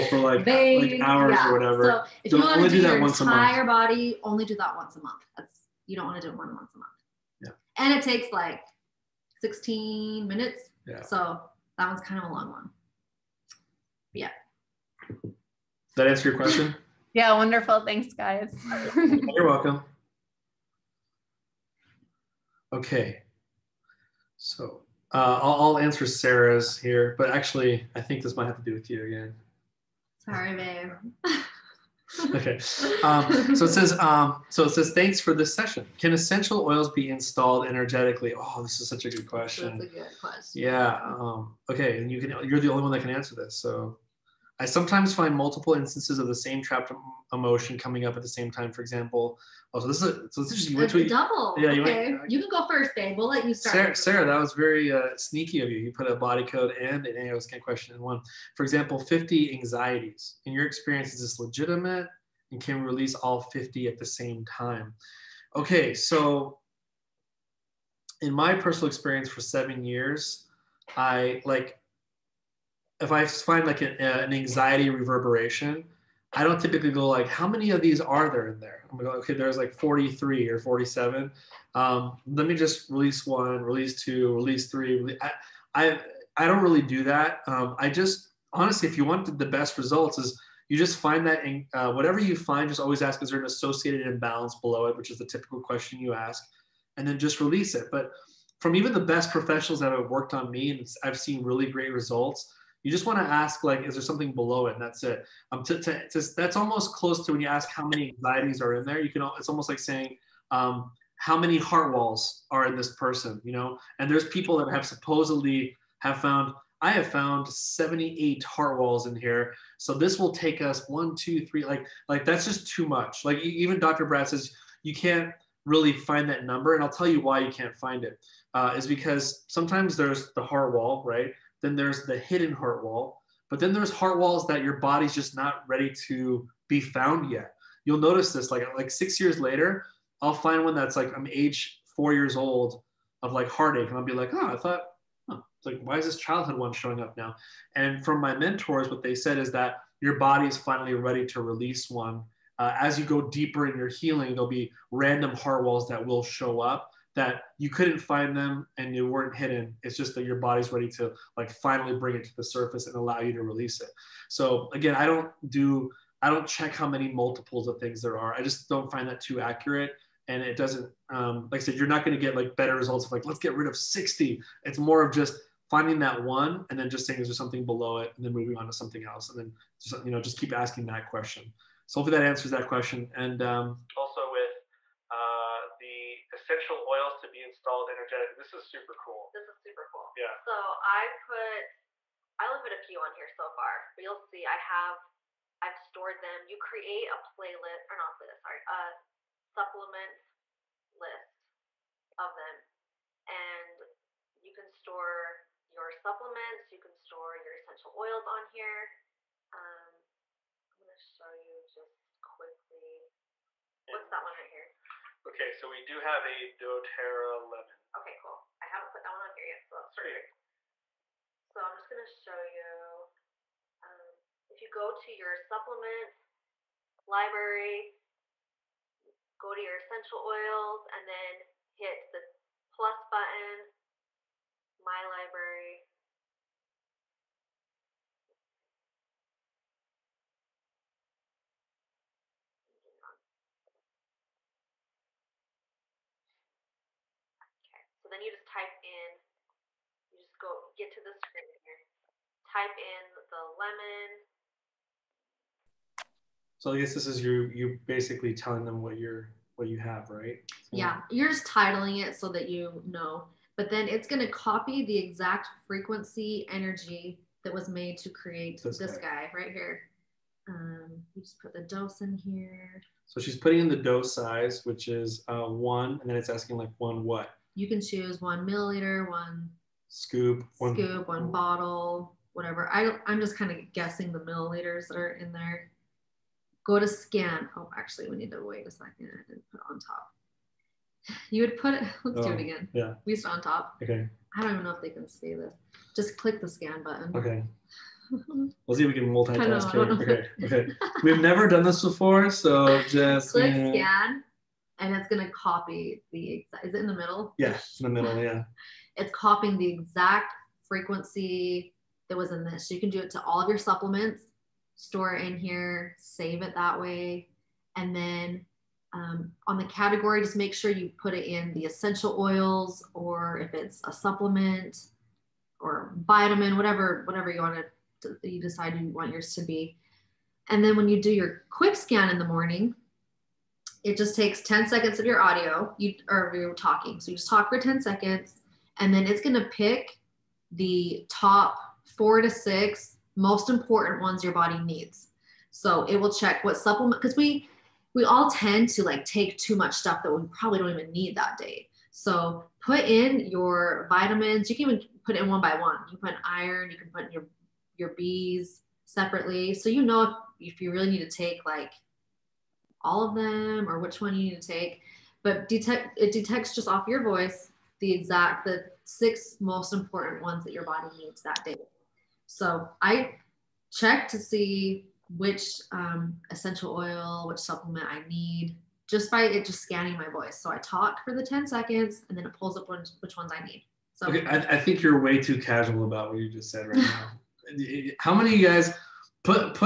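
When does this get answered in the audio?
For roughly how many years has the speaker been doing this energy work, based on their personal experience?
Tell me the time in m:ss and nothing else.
1:09.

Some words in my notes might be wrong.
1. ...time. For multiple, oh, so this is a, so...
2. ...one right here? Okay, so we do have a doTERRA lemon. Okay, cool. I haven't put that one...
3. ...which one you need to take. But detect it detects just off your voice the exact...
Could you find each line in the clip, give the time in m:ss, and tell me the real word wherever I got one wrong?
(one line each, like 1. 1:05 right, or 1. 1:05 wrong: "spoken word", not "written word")
1. 0:48 wrong: "example", not "multiple"
2. 3:34 right
3. 6:03 right.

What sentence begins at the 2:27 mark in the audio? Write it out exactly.
And from my mentors, what they said is that your body is finally ready to release one.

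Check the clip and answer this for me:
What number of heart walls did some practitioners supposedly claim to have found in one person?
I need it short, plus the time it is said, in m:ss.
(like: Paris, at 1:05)
78, at 1:57.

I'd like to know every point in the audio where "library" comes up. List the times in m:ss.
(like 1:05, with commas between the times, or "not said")
3:47, 3:55.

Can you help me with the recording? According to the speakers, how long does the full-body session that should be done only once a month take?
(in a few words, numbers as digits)
16 minutes.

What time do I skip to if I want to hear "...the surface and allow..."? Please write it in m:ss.
2:42.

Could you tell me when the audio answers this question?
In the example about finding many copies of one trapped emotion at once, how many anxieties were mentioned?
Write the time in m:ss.
0:58.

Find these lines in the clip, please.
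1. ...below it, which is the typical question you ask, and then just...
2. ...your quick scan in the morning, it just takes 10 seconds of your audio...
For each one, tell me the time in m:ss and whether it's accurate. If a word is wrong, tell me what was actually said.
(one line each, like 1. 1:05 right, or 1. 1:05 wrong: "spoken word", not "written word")
1. 1:34 right
2. 5:31 right.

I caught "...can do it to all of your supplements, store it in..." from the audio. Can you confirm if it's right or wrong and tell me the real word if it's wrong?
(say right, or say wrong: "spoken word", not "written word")
right.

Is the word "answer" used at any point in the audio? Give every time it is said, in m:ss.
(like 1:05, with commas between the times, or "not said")
0:16, 0:25, 0:43, 3:02.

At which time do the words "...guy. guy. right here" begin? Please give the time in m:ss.
4:28.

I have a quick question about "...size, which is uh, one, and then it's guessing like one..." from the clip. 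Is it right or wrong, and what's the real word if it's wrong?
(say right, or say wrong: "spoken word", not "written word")
wrong: "asking", not "guessing".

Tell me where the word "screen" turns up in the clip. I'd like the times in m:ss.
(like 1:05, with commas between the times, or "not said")
4:11.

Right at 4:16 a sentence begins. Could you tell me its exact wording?
So I guess this is you you basically telling them what you're what you have, right?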